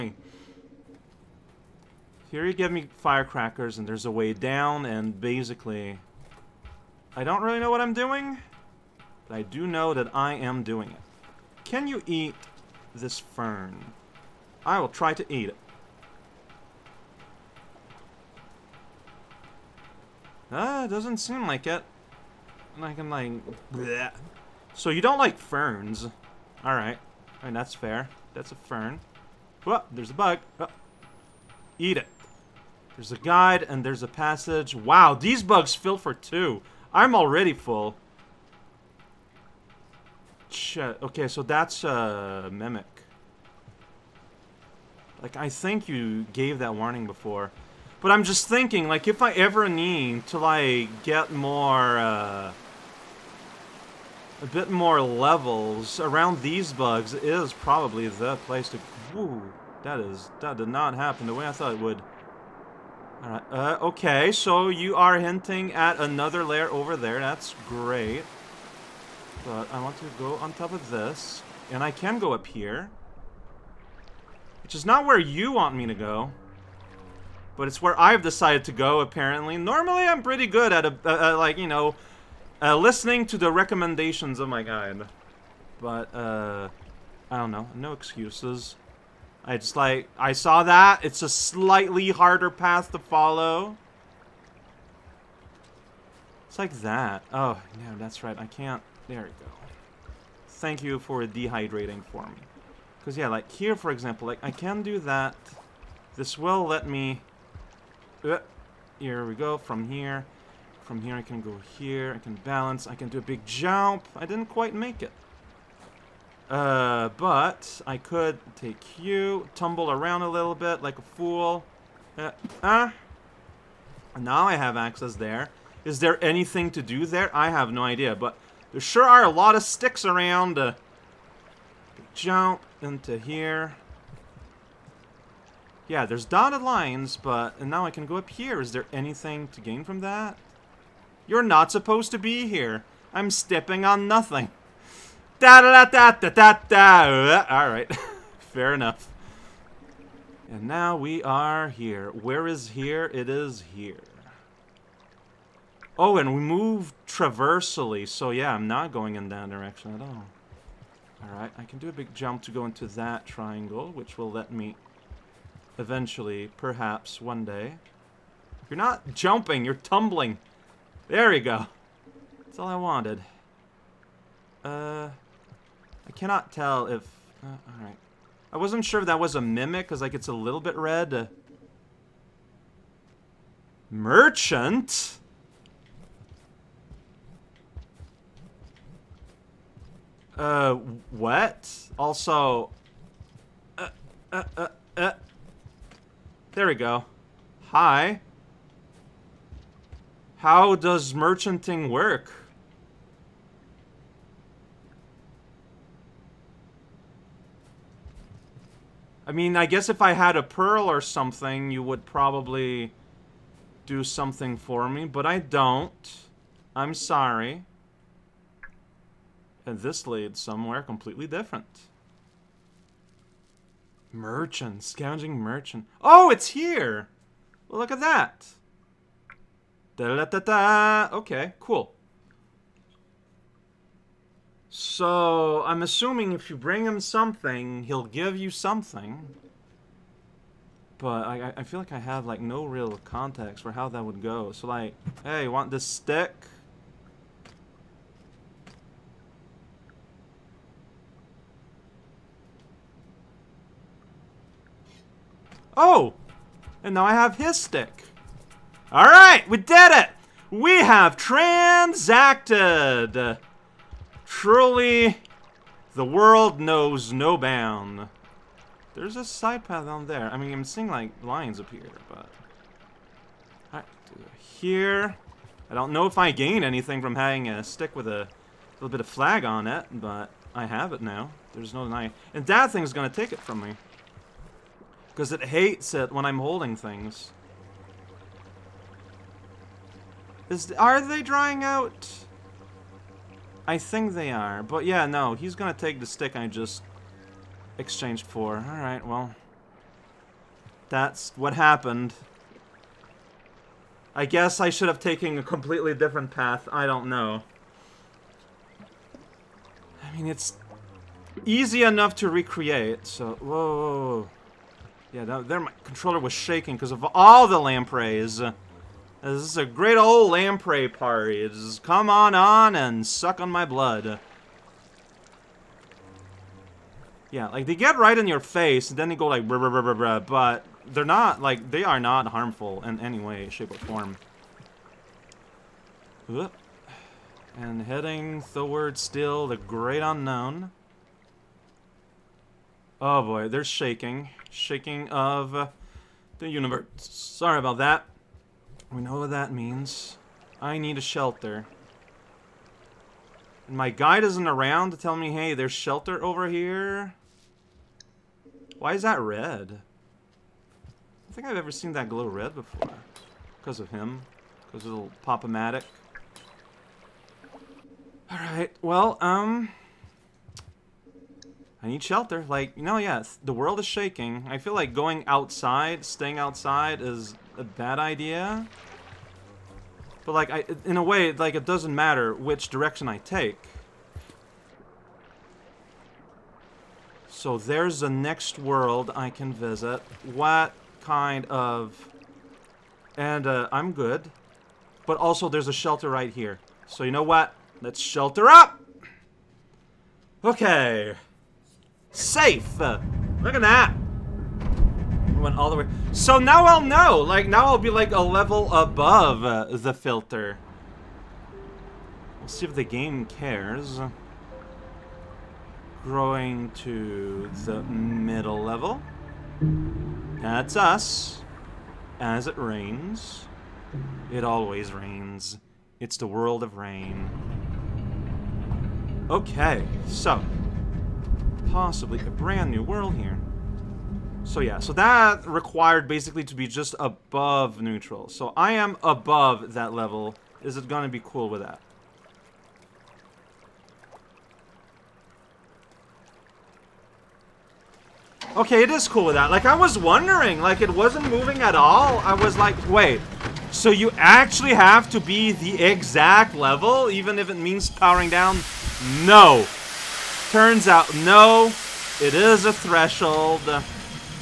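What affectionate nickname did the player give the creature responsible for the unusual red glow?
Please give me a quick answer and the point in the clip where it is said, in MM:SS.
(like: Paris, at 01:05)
Pop-O-Matic, at 06:05.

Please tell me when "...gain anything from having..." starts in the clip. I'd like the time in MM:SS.
04:36.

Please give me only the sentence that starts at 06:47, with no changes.
Like, now I'll be like a level above uh, the filter.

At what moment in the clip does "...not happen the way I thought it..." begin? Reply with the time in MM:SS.
01:00.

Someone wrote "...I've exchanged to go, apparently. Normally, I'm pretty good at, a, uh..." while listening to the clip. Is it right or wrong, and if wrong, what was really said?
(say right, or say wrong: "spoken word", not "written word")
wrong: "decided", not "exchanged".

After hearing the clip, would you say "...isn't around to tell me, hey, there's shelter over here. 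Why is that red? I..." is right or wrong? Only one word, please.
right.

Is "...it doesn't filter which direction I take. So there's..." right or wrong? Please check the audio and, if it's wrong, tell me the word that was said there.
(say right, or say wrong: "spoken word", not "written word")
wrong: "matter", not "filter".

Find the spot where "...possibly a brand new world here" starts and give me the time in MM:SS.
07:11.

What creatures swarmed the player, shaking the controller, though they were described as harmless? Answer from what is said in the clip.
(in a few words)
Lampreys.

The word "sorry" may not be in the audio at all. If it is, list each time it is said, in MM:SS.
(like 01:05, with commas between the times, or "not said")
03:36, 05:46.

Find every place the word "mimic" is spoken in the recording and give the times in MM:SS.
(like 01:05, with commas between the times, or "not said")
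00:42, 02:59.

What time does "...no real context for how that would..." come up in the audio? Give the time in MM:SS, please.
04:02.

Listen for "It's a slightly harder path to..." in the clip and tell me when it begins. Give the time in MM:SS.
01:31.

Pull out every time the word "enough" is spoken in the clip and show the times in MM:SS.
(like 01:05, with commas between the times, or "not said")
02:28, 05:11.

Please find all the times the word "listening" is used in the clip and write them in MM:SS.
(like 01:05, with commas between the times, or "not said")
01:22.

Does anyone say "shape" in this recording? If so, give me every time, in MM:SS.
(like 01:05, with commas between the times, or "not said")
05:33.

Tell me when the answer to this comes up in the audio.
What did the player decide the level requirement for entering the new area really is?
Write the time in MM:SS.
07:42.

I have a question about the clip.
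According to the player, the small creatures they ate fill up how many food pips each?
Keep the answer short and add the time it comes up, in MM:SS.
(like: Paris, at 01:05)
2, at 00:36.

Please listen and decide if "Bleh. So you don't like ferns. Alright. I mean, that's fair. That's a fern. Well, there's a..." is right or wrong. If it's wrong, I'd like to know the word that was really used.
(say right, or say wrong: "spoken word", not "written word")
right.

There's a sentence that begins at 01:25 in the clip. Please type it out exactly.
But, uh, I don't know, no excuses.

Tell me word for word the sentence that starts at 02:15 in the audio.
Yeah, there's dotted lines, but and now I can go up here.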